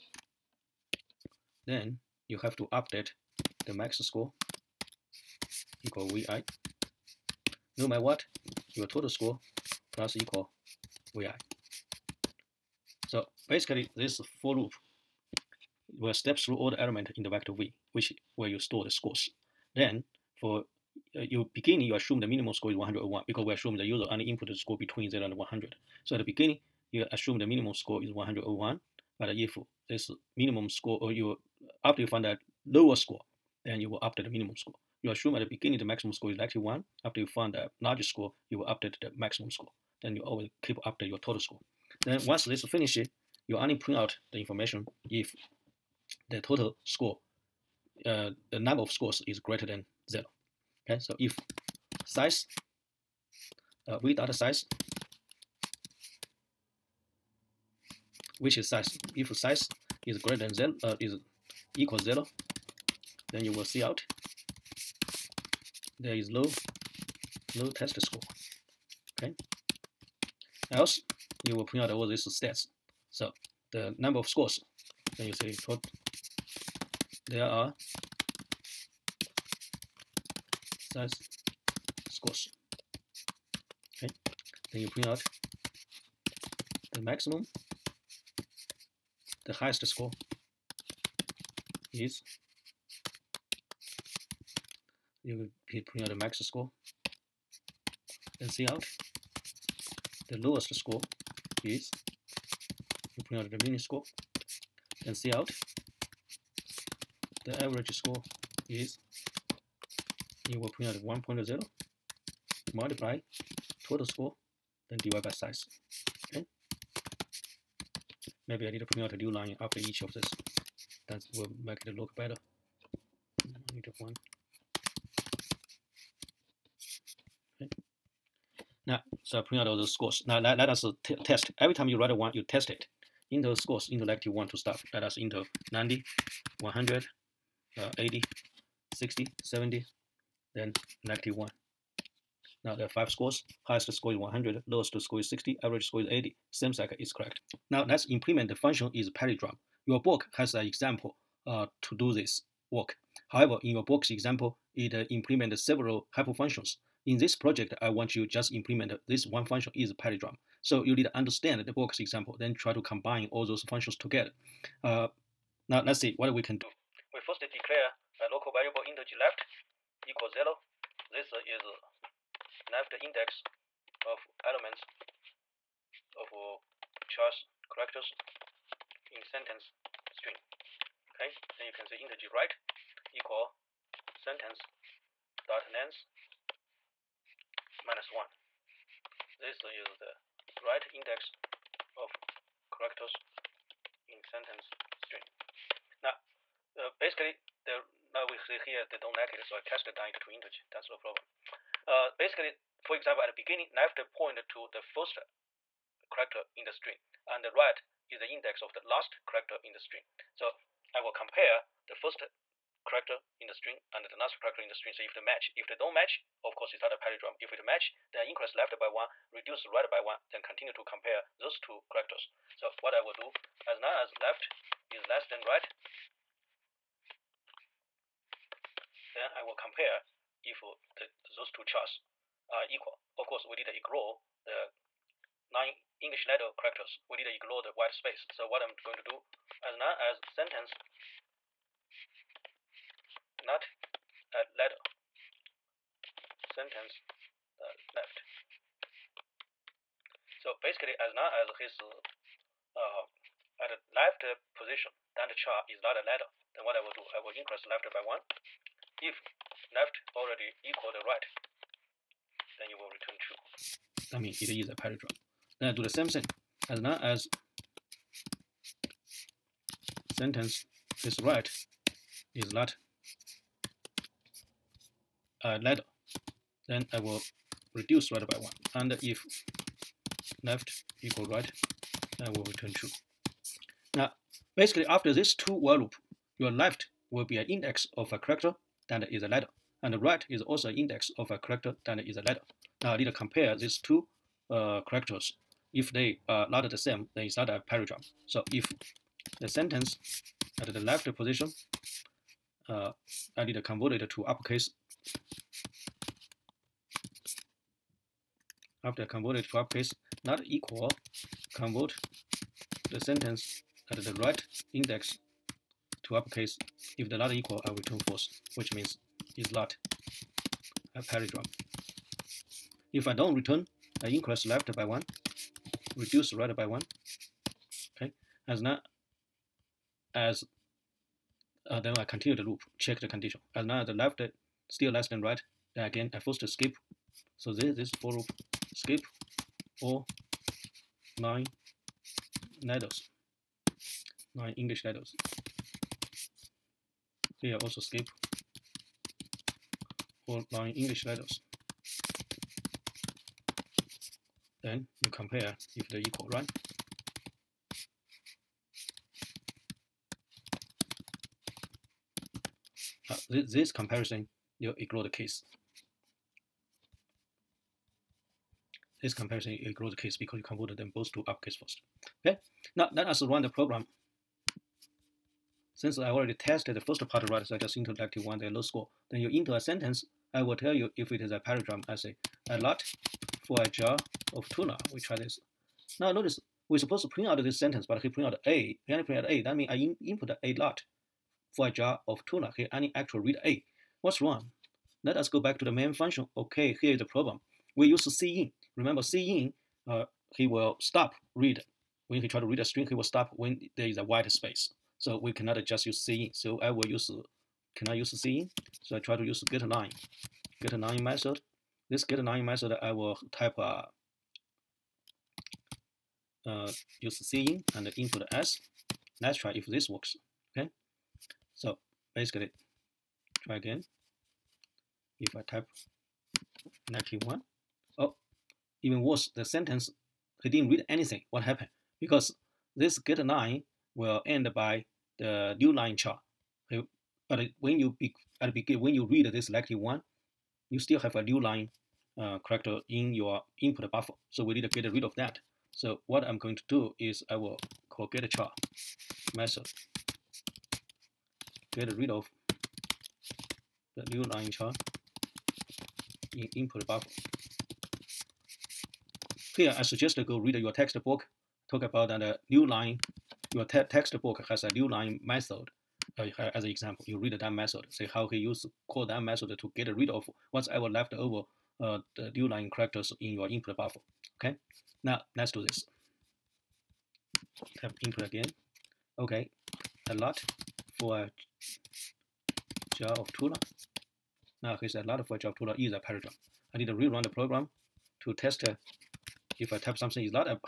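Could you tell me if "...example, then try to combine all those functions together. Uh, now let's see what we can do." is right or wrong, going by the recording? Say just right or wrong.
right.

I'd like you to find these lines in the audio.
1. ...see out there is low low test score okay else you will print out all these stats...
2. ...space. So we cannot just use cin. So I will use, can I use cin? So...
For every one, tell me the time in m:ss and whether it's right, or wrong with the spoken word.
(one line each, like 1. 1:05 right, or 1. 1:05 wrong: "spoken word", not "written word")
1. 1:03 right
2. 6:44 right.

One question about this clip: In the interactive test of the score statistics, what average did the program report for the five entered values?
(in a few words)
80.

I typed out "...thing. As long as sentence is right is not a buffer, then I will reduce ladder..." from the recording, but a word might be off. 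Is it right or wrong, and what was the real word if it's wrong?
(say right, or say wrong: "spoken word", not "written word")
wrong: "ladder", not "buffer".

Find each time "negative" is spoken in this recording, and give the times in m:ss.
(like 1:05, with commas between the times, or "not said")
2:21, 7:06.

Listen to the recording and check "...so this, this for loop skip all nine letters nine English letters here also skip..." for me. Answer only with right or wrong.
right.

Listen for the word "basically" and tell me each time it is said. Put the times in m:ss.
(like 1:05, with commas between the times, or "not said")
0:13, 3:16, 3:22, 4:10, 4:44, 7:02.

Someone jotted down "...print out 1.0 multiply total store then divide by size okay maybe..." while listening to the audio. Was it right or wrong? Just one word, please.
wrong.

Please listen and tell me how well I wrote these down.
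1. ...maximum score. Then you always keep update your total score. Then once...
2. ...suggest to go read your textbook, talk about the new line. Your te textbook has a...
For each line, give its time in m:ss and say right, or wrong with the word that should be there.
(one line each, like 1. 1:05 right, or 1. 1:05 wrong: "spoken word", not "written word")
1. 0:39 right
2. 7:39 right.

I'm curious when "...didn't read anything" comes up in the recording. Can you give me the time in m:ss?
7:10.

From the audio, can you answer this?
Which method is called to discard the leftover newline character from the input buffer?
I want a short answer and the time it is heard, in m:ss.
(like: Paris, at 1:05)
getChar, at 7:28.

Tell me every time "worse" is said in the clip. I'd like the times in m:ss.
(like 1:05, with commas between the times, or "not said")
7:09.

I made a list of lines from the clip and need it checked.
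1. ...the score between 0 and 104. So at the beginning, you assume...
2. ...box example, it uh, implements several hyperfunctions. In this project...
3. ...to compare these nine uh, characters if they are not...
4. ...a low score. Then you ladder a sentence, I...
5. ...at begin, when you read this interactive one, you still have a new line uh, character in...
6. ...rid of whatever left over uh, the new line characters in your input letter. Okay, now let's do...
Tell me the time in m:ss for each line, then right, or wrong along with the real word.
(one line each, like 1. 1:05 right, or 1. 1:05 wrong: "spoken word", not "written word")
1. 0:24 wrong: "100", not "104"
2. 2:33 right
3. 4:53 wrong: "two", not "nine"
4. 6:18 wrong: "enter", not "ladder"
5. 7:18 wrong: "selective", not "interactive"
6. 7:49 wrong: "buffer", not "letter".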